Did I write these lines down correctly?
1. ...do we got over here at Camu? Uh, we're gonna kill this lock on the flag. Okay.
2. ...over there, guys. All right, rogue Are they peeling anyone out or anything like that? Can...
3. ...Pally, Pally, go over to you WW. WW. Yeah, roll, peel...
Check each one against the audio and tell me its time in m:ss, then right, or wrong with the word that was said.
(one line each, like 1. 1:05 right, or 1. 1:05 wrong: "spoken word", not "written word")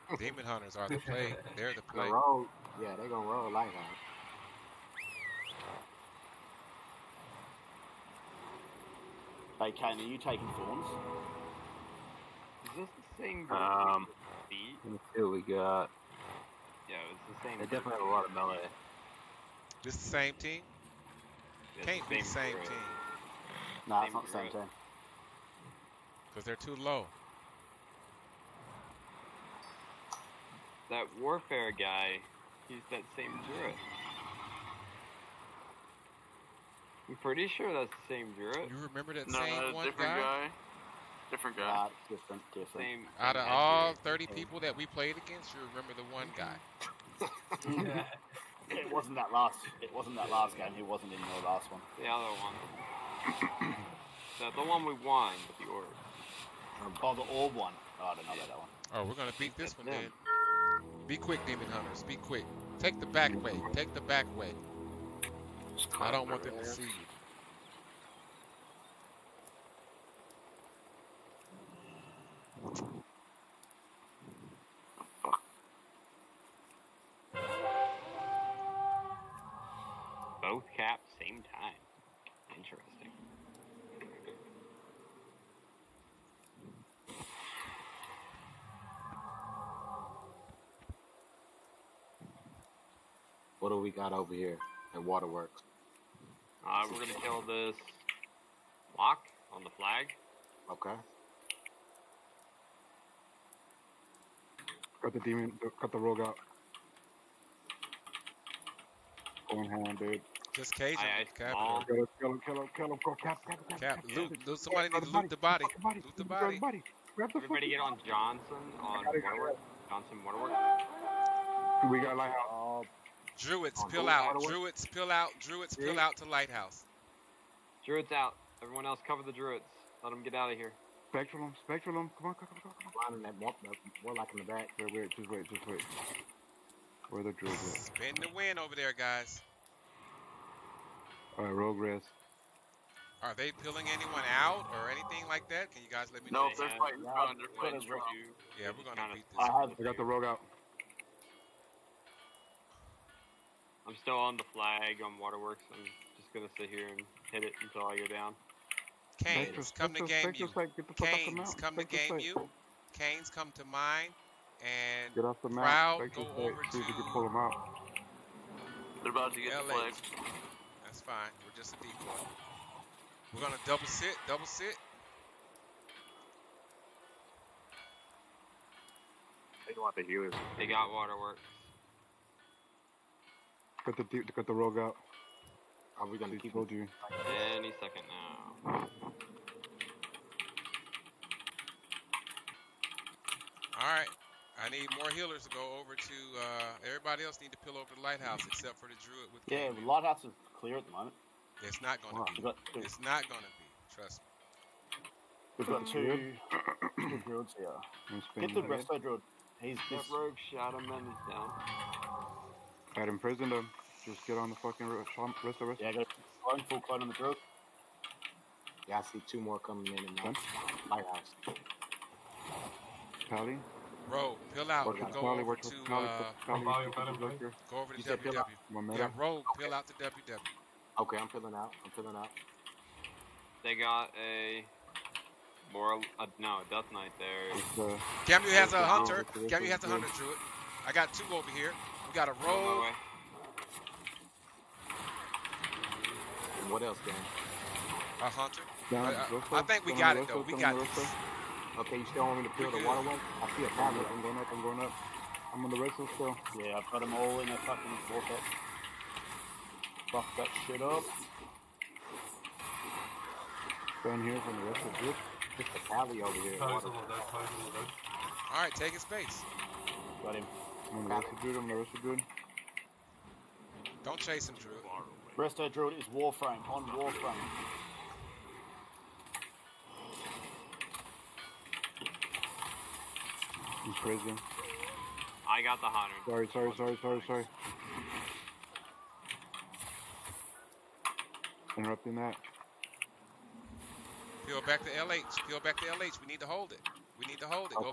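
1. 1:33 wrong: "Waterworks", not "Camu"
2. 2:18 right
3. 3:46 right.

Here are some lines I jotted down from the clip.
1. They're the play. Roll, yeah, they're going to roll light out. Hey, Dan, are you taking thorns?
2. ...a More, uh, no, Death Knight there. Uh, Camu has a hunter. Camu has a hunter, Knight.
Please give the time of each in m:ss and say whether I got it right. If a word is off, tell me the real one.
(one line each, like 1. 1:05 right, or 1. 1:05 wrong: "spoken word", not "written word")
1. 0:01 wrong: "Kane", not "Dan"
2. 3:54 wrong: "Druid", not "Knight".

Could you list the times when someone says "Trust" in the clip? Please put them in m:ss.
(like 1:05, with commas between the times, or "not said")
3:23.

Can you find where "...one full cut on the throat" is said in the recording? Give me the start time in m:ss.
3:36.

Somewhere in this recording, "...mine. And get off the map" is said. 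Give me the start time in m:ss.
2:43.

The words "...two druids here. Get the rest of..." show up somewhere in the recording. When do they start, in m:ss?
3:27.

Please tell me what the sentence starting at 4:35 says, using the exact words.
Rest our druid is warframe, on warframe.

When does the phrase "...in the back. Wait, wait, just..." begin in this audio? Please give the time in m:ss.
2:14.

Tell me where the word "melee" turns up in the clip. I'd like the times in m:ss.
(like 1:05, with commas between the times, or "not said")
0:18.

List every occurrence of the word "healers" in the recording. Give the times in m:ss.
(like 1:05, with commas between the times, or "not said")
3:00, 3:15.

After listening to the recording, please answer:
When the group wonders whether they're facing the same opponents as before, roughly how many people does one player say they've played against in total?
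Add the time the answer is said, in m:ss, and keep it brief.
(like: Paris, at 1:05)
30, at 0:44.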